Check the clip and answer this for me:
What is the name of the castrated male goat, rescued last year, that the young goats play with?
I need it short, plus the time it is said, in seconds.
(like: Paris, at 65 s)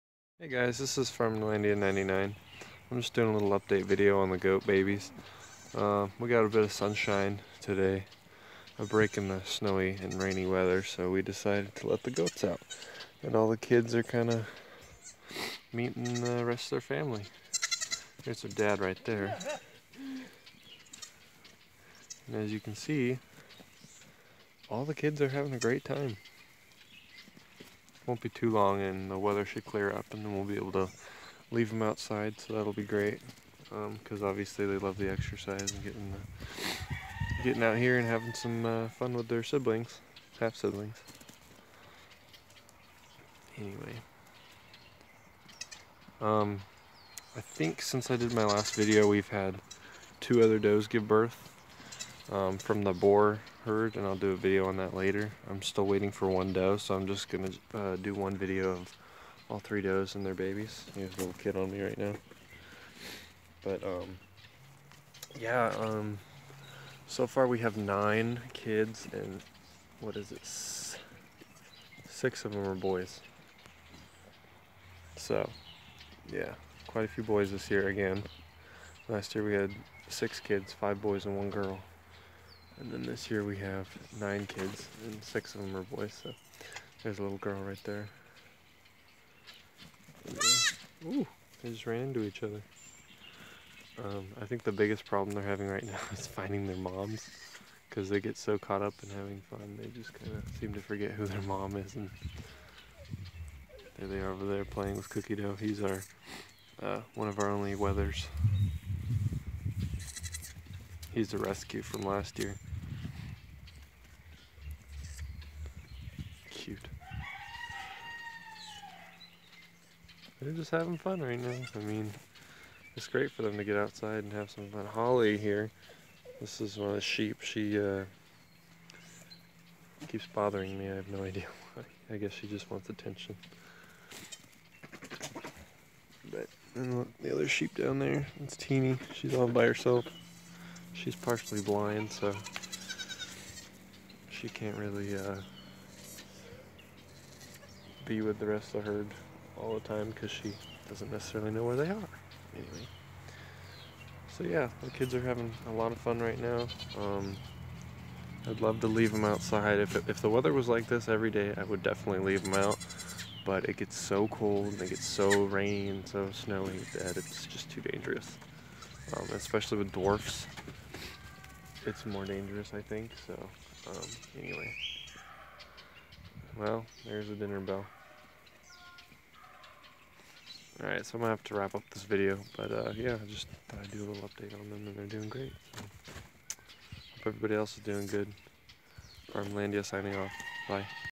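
Cookie Dough, at 105 s.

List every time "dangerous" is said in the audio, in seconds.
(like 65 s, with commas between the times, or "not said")
167 s, 172 s.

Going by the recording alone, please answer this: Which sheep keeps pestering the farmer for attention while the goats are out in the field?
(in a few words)
Holly.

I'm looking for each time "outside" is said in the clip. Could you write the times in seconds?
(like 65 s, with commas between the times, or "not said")
31 s, 123 s, 159 s.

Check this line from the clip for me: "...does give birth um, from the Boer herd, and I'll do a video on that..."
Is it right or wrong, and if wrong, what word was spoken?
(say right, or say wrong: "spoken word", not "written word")
right.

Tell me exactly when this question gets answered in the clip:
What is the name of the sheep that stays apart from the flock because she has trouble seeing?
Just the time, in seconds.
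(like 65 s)
138 s.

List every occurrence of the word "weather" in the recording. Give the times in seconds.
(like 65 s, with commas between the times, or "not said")
10 s, 29 s, 160 s.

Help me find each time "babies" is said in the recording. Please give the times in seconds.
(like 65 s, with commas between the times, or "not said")
4 s, 60 s.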